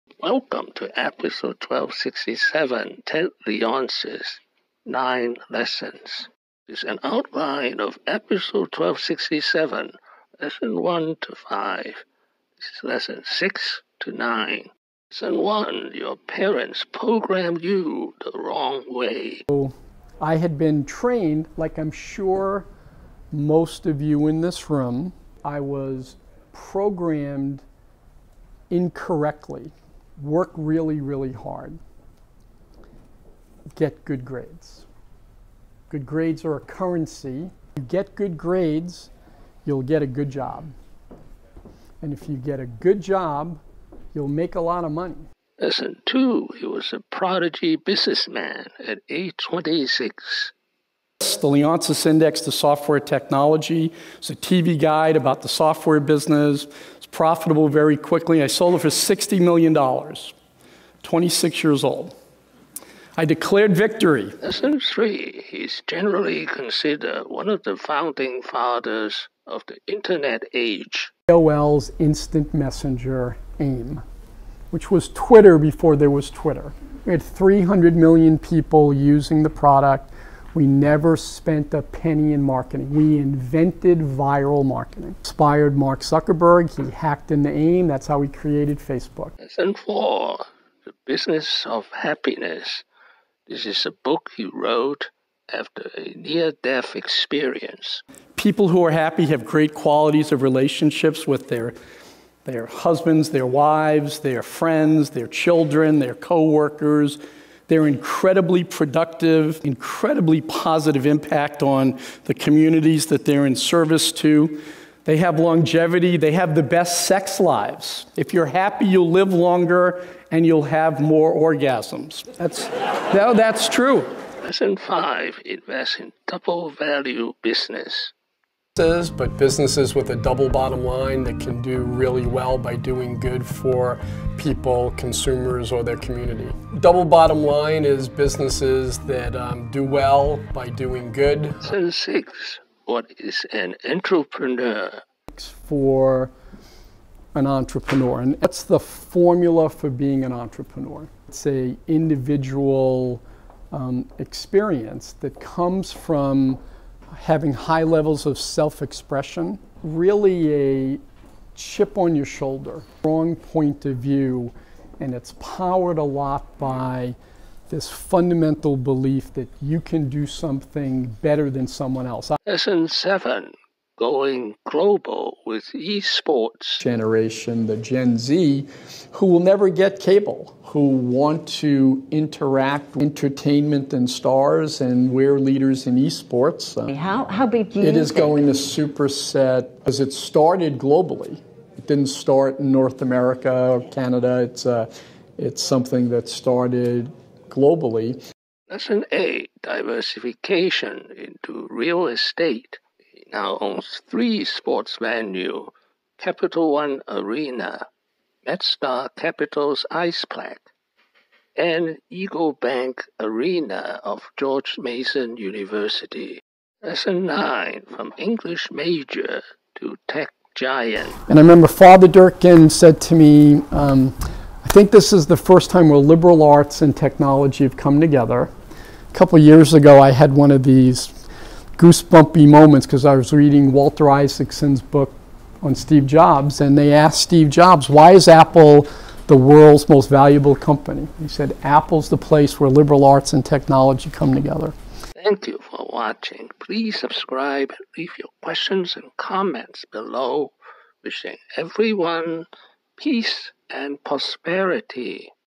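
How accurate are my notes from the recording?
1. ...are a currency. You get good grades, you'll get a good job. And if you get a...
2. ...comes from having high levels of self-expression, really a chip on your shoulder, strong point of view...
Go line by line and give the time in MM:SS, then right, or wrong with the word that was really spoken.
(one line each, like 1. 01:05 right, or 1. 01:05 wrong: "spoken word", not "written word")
1. 00:36 right
2. 02:35 right.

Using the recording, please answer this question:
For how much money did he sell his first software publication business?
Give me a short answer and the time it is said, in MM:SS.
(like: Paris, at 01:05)
$60 million, at 00:58.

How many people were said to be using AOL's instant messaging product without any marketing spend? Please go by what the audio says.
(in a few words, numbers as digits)
300 million.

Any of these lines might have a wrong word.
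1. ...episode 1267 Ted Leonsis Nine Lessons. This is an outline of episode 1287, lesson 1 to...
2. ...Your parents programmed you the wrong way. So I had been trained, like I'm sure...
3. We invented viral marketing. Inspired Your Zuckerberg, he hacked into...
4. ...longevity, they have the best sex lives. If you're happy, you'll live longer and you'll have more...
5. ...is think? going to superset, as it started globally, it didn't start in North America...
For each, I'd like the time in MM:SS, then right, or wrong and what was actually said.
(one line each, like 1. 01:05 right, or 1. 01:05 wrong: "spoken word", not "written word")
1. 00:00 wrong: "1267", not "1287"
2. 00:15 right
3. 01:22 wrong: "Mark", not "Your"
4. 01:55 right
5. 03:07 right.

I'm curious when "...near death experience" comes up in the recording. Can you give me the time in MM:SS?
01:36.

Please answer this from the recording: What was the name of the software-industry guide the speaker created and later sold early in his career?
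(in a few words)
Leonsis Index to Software Technology.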